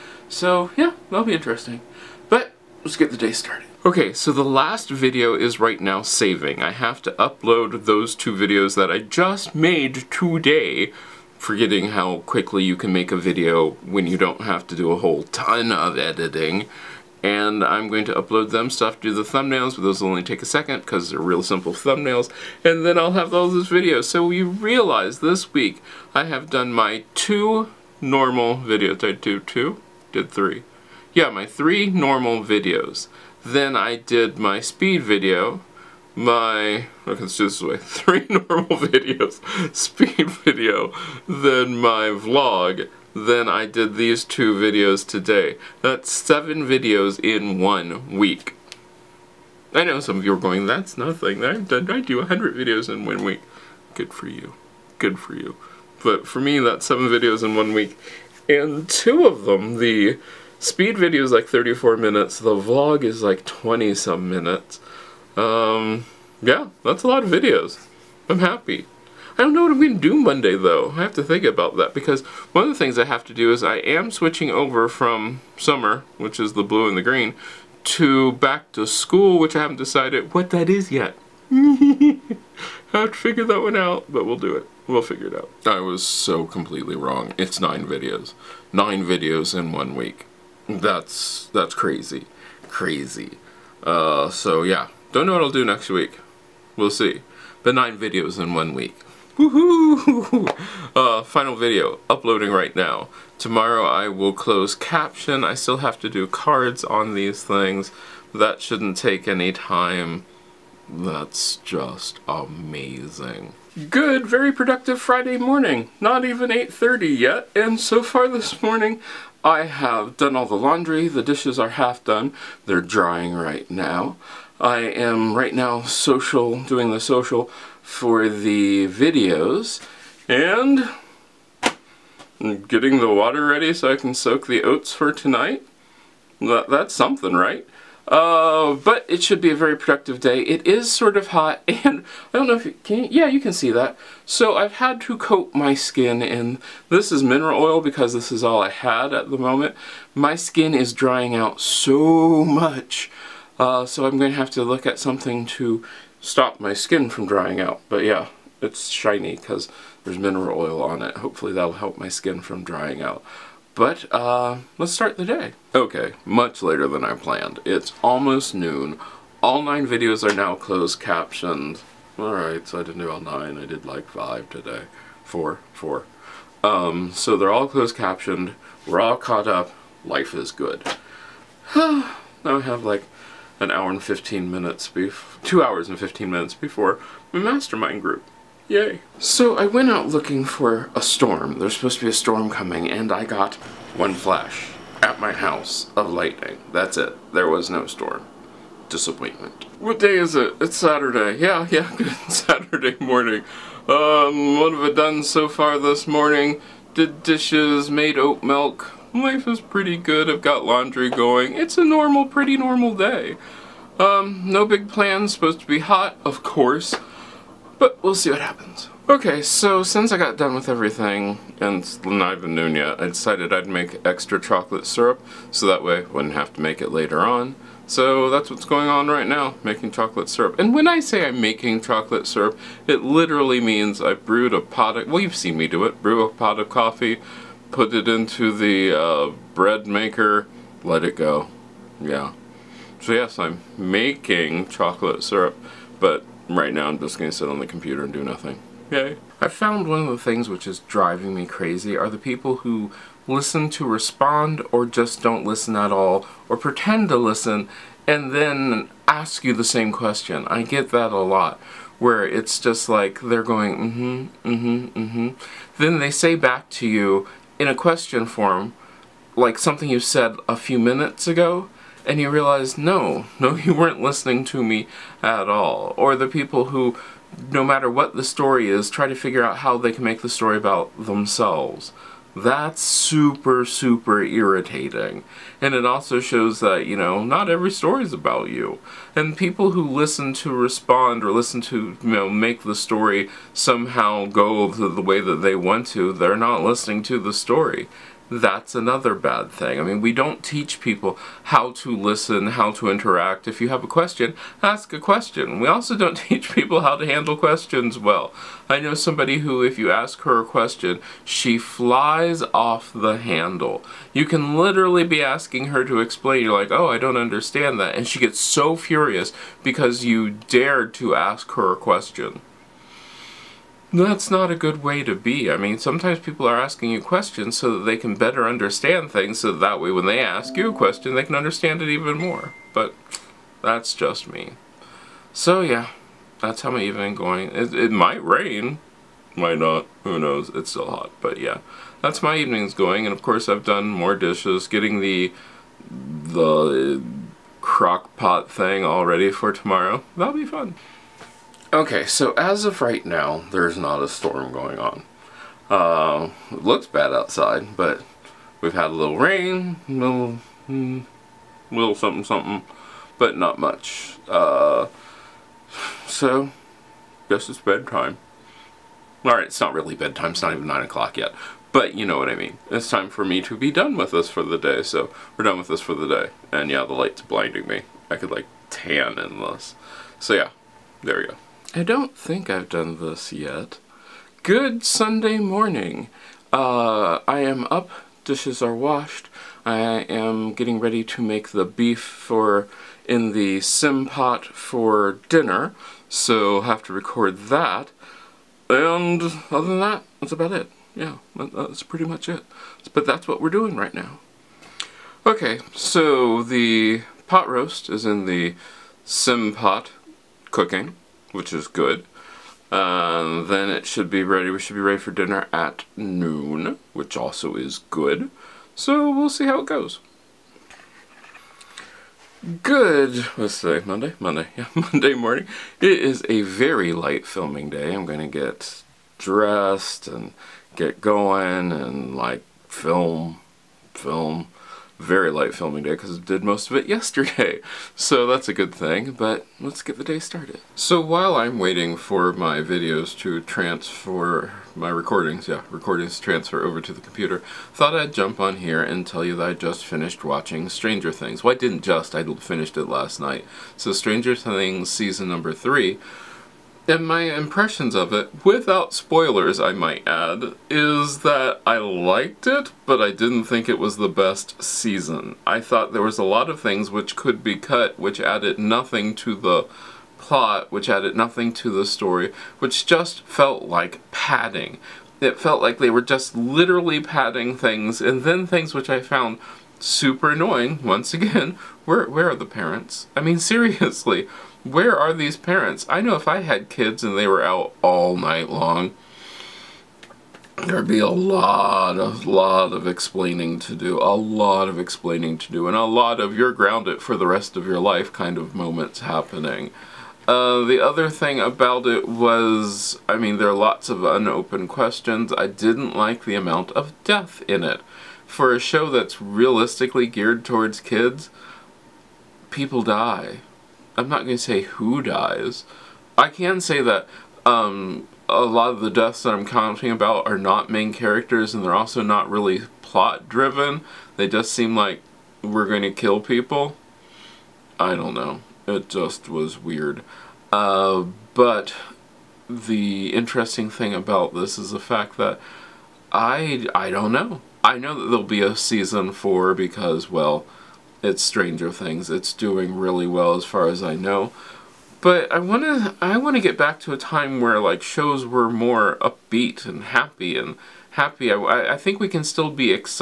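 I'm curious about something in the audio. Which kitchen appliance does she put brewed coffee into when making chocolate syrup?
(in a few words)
Bread maker.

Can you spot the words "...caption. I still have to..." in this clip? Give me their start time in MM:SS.
01:44.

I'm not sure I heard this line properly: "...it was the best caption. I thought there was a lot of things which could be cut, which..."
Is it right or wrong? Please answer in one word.
wrong.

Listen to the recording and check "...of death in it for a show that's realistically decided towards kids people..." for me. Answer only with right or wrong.
wrong.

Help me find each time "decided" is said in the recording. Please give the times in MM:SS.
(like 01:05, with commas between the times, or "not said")
01:19, 03:43.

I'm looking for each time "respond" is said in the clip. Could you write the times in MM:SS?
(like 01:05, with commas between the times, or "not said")
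04:13, 04:50.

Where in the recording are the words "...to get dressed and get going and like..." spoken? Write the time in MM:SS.
07:08.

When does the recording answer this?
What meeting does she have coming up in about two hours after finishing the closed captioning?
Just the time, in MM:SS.
03:07.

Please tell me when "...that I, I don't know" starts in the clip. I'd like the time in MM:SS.
08:55.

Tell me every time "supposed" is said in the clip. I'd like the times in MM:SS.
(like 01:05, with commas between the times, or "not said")
03:11, 03:35.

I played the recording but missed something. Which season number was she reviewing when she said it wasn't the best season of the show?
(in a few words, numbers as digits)
3.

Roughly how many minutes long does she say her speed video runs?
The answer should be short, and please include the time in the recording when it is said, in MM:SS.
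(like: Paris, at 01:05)
34 minutes, at 01:01.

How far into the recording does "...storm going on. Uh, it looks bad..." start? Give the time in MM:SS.
05:54.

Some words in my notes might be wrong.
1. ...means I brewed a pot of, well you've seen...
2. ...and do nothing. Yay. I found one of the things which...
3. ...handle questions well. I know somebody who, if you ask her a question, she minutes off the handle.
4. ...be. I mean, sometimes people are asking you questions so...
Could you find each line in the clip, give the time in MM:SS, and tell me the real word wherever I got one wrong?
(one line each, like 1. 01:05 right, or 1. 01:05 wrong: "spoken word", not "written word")
1. 03:53 right
2. 04:08 right
3. 05:07 wrong: "flies", not "minutes"
4. 05:25 right.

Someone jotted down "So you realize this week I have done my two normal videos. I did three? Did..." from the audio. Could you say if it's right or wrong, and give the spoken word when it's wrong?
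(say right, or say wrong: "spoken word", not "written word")
wrong: "two", not "three".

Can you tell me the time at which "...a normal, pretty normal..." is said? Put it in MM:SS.
03:31.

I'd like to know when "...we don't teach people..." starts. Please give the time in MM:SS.
05:00.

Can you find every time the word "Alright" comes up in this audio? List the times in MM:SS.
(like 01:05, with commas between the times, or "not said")
02:52, 06:09.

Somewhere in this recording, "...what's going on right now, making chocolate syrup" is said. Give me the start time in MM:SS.
03:48.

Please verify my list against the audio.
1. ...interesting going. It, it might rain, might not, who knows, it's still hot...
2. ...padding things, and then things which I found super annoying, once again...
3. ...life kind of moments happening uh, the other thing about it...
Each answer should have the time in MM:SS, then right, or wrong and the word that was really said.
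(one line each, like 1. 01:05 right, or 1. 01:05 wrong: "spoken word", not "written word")
1. 05:36 wrong: "evening", not "interesting"
2. 07:57 right
3. 08:17 right.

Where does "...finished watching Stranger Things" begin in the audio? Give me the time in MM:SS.
07:29.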